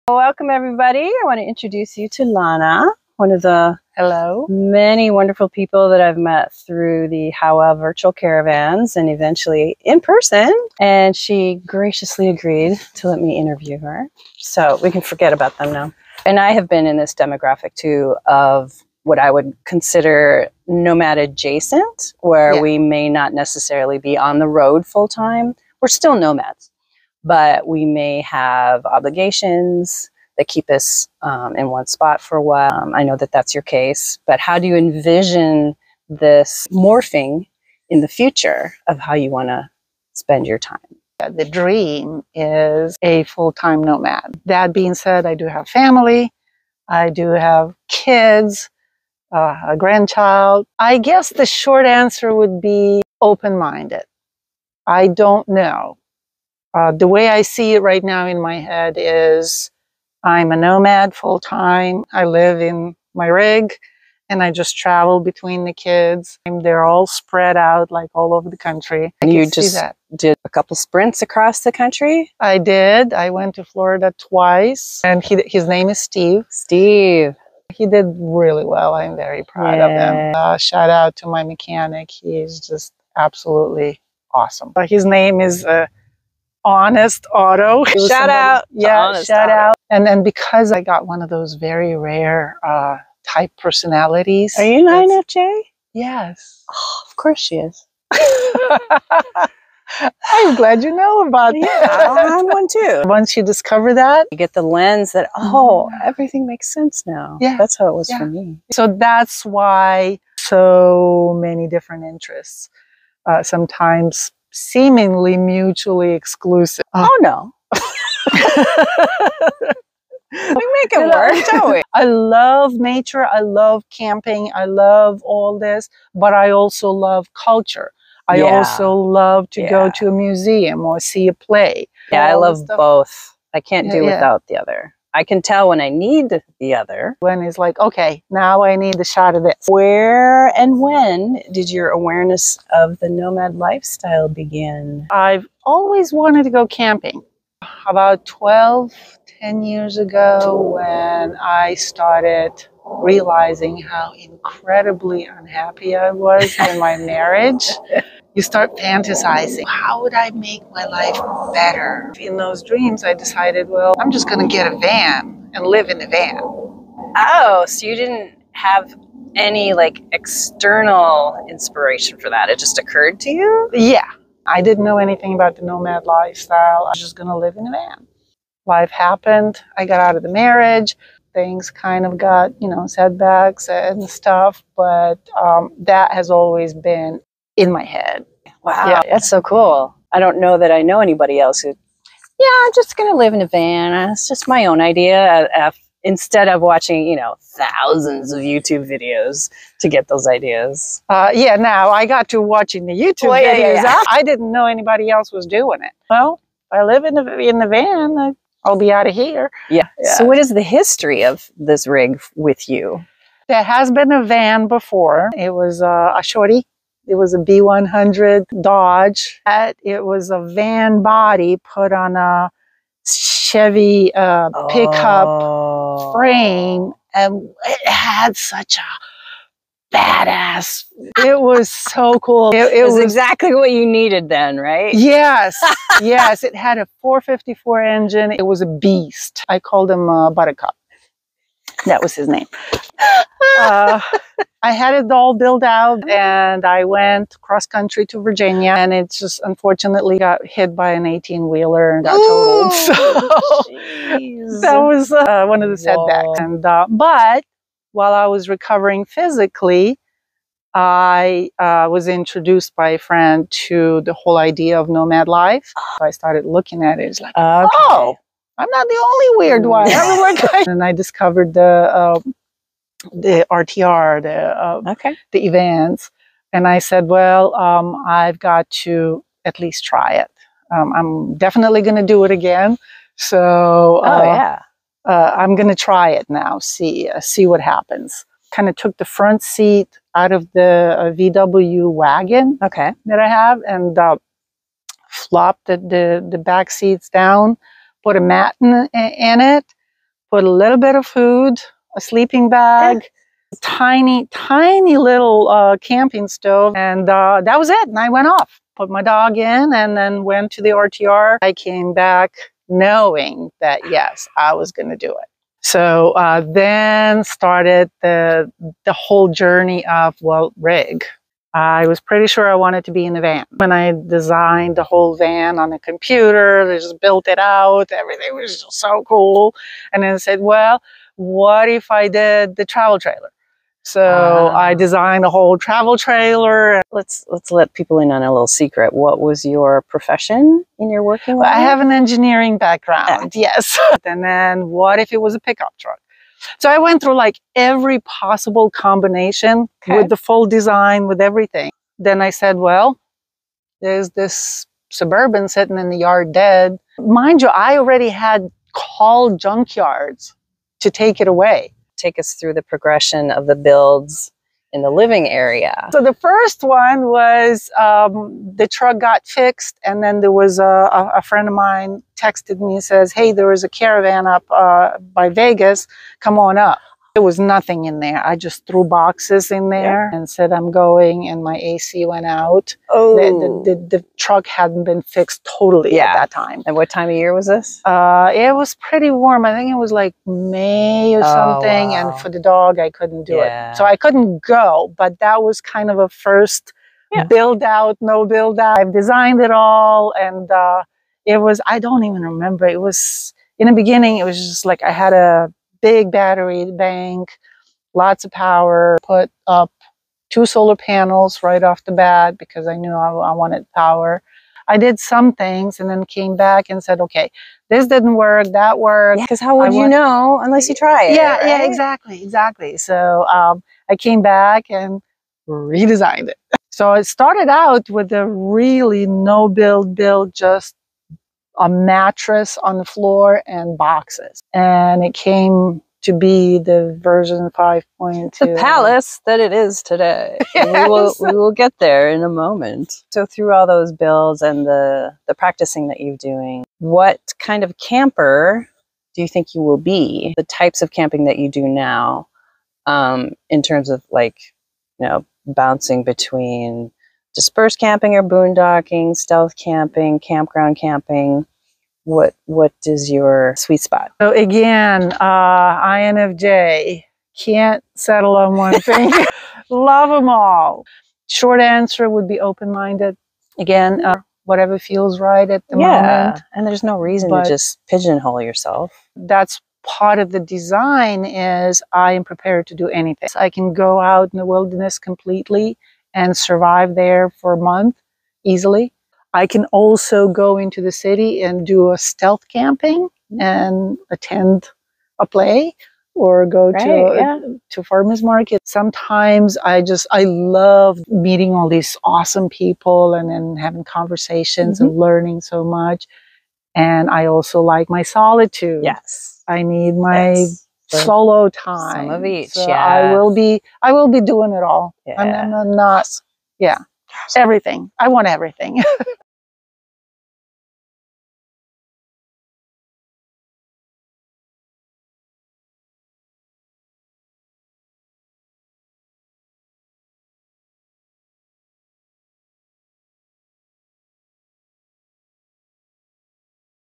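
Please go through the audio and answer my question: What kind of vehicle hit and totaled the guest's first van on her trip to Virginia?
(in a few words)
18 wheeler.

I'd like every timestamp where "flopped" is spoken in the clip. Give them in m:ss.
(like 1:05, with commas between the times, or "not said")
4:55.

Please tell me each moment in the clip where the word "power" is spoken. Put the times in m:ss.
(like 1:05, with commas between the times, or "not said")
6:48, 6:53.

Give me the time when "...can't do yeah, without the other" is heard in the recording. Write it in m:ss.
2:13.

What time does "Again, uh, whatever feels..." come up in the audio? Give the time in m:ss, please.
7:53.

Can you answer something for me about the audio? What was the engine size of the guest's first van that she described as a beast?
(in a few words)
454.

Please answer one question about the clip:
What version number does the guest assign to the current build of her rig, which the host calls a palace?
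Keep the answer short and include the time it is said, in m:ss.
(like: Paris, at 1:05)
5.2, at 7:17.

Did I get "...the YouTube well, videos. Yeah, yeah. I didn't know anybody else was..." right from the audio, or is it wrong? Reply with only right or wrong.
right.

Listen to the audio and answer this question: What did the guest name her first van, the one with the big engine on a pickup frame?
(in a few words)
Buttercup.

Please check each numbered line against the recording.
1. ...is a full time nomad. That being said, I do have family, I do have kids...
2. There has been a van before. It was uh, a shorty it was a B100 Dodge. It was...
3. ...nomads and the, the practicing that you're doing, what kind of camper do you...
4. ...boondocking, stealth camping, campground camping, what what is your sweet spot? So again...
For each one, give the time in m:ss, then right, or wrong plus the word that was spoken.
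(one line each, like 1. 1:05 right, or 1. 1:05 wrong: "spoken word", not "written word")
1. 0:42 right
2. 3:33 right
3. 7:23 wrong: "builds", not "nomads"
4. 7:38 right.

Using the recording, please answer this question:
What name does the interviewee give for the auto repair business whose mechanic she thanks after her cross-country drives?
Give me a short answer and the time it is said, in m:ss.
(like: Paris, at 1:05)
Honest Auto, at 1:26.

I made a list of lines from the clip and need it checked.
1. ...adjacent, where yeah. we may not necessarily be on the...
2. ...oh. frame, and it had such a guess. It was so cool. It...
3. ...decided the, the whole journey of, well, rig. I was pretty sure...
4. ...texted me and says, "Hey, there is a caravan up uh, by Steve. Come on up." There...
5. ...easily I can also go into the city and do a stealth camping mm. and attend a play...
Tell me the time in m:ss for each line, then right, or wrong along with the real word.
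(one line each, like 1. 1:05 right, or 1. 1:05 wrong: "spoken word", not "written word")
1. 0:21 right
2. 3:45 wrong: "badass", not "guess"
3. 5:17 wrong: "started", not "decided"
4. 6:12 wrong: "Vegas", not "Steve"
5. 8:08 right.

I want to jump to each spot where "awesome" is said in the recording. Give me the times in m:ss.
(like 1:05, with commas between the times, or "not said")
1:24, 8:22.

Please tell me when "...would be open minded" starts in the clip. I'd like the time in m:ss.
0:52.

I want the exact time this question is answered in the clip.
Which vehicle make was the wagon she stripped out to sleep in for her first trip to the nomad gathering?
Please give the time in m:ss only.
4:51.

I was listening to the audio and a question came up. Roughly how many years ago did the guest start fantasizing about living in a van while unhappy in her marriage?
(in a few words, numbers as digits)
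12.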